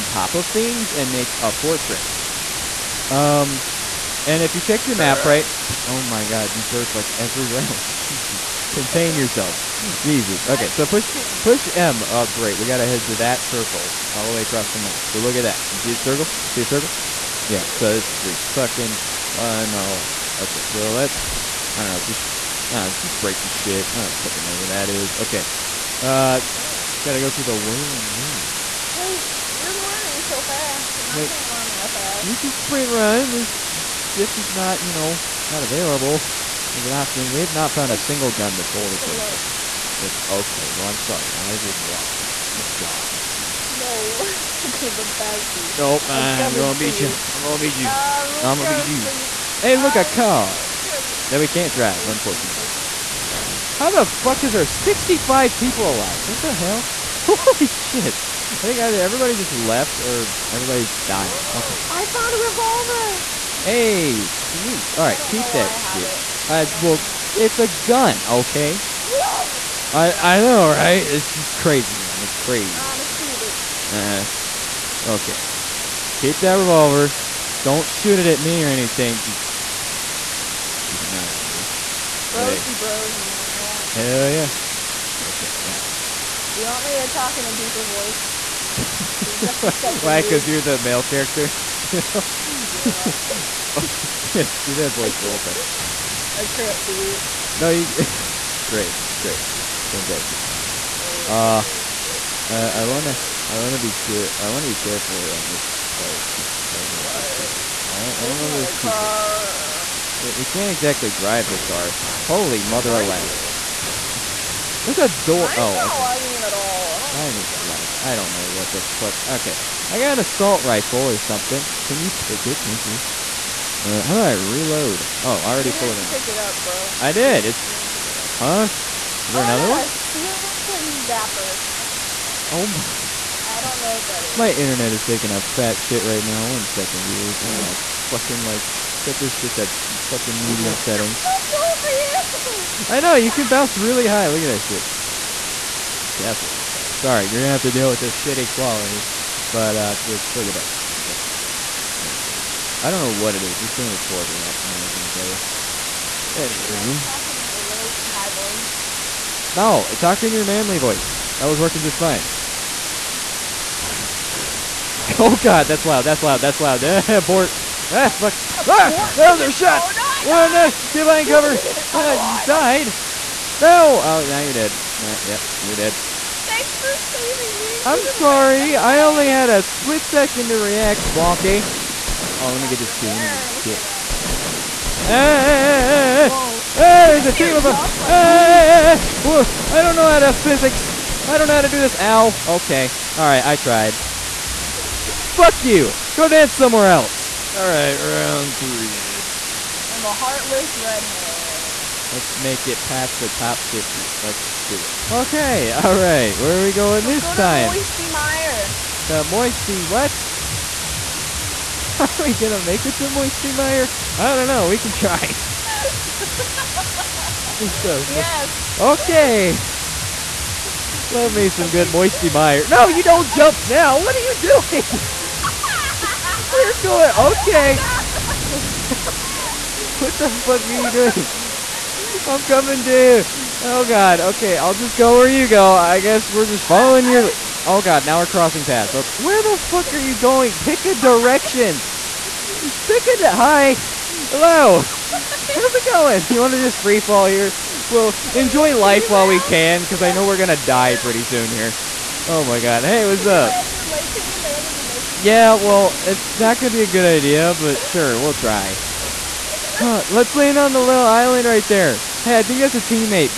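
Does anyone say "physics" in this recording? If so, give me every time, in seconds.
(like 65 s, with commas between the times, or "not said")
190 s.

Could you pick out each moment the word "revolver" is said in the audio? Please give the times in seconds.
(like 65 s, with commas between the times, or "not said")
62 s, 76 s.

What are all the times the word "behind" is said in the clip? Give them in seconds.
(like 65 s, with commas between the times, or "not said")
170 s.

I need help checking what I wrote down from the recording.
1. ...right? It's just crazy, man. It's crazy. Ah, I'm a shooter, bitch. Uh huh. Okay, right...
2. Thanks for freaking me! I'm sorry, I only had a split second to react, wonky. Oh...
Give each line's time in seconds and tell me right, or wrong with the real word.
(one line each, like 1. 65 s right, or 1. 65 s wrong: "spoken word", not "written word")
1. 70 s right
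2. 176 s wrong: "saving", not "freaking".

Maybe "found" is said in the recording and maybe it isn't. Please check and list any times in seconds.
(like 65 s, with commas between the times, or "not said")
37 s, 62 s.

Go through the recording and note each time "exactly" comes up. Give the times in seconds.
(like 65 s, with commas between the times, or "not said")
110 s.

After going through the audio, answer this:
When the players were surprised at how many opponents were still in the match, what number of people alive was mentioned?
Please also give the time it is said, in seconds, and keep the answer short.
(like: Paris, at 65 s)
65, at 54 s.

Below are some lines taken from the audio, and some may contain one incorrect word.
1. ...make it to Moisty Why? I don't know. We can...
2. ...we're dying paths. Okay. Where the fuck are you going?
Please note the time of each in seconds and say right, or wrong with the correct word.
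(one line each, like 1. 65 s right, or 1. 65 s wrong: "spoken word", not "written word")
1. 212 s wrong: "Mire", not "Why"
2. 238 s wrong: "crossing", not "dying".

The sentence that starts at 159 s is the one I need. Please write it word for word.
No, talk in your manly voice.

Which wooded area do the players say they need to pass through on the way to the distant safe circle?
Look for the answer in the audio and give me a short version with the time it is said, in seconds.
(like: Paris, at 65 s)
Wailing Woods, at 27 s.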